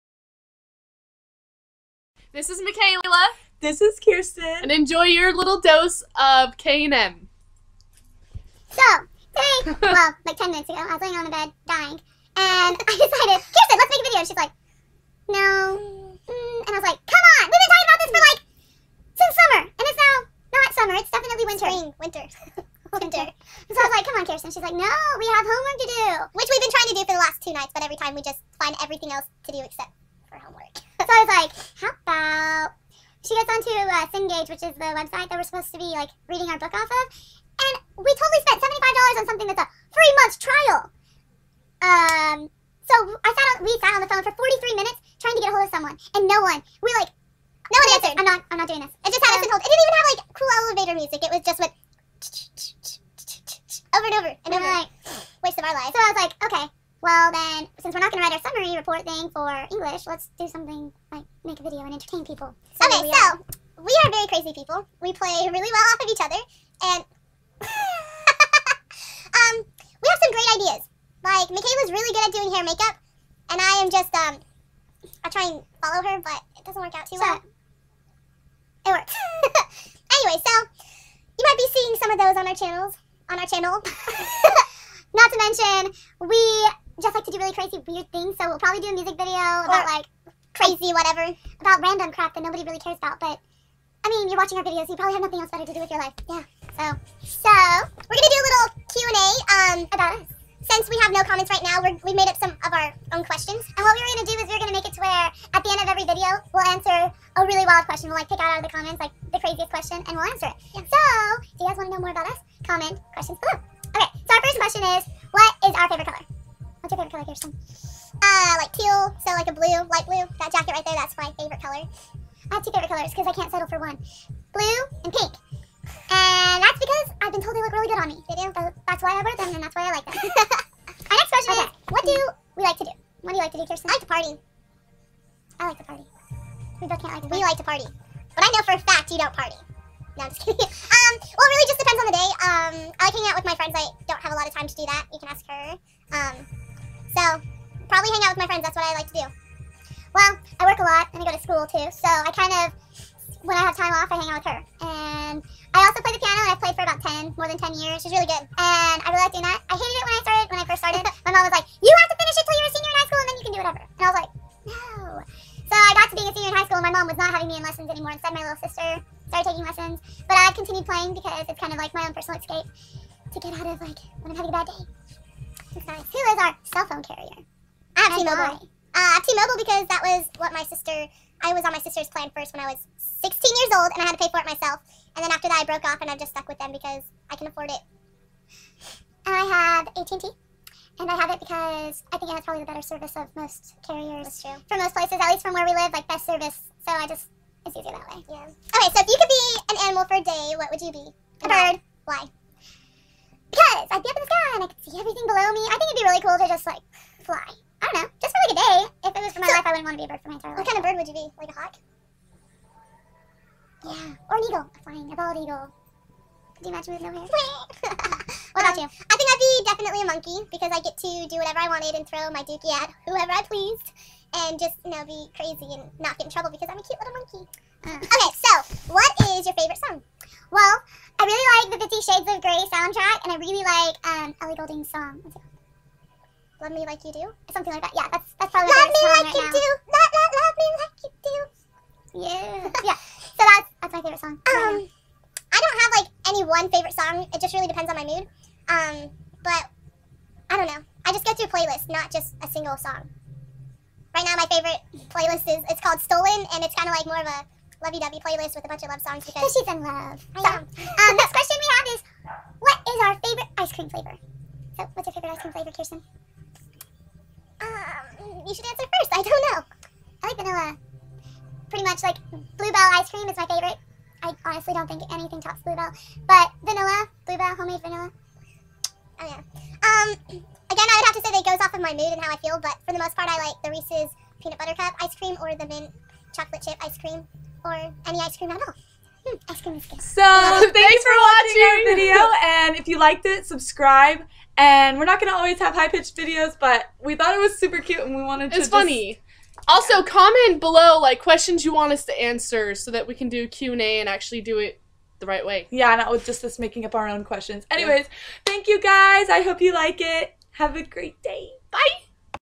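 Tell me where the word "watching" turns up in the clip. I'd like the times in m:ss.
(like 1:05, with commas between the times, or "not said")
1:34, 4:51.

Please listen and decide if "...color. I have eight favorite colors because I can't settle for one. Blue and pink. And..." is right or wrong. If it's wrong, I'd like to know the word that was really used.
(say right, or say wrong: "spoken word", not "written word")
wrong: "two", not "eight".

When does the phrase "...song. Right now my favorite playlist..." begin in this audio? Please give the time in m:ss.
4:12.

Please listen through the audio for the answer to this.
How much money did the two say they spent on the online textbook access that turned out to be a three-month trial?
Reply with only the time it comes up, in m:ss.
0:38.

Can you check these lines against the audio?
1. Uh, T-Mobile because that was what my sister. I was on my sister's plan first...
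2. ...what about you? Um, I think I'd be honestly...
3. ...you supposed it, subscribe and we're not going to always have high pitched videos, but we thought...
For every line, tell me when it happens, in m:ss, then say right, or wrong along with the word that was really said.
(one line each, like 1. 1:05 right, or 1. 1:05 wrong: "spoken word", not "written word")
1. 2:58 right
2. 3:38 wrong: "definitely", not "honestly"
3. 4:52 wrong: "liked", not "supposed".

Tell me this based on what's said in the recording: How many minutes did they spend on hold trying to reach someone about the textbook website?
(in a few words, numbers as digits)
43.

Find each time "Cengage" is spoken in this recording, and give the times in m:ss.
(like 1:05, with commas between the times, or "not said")
0:34.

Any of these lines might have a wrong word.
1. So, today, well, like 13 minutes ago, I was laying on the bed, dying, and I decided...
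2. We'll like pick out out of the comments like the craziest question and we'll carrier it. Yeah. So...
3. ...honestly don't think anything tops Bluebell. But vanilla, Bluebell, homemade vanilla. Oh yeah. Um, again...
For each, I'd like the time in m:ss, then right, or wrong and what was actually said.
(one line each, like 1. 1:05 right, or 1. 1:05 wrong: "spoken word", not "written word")
1. 0:08 wrong: "10", not "13"
2. 1:48 wrong: "answer", not "carrier"
3. 4:34 right.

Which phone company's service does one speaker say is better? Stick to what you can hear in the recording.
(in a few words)
AT&T.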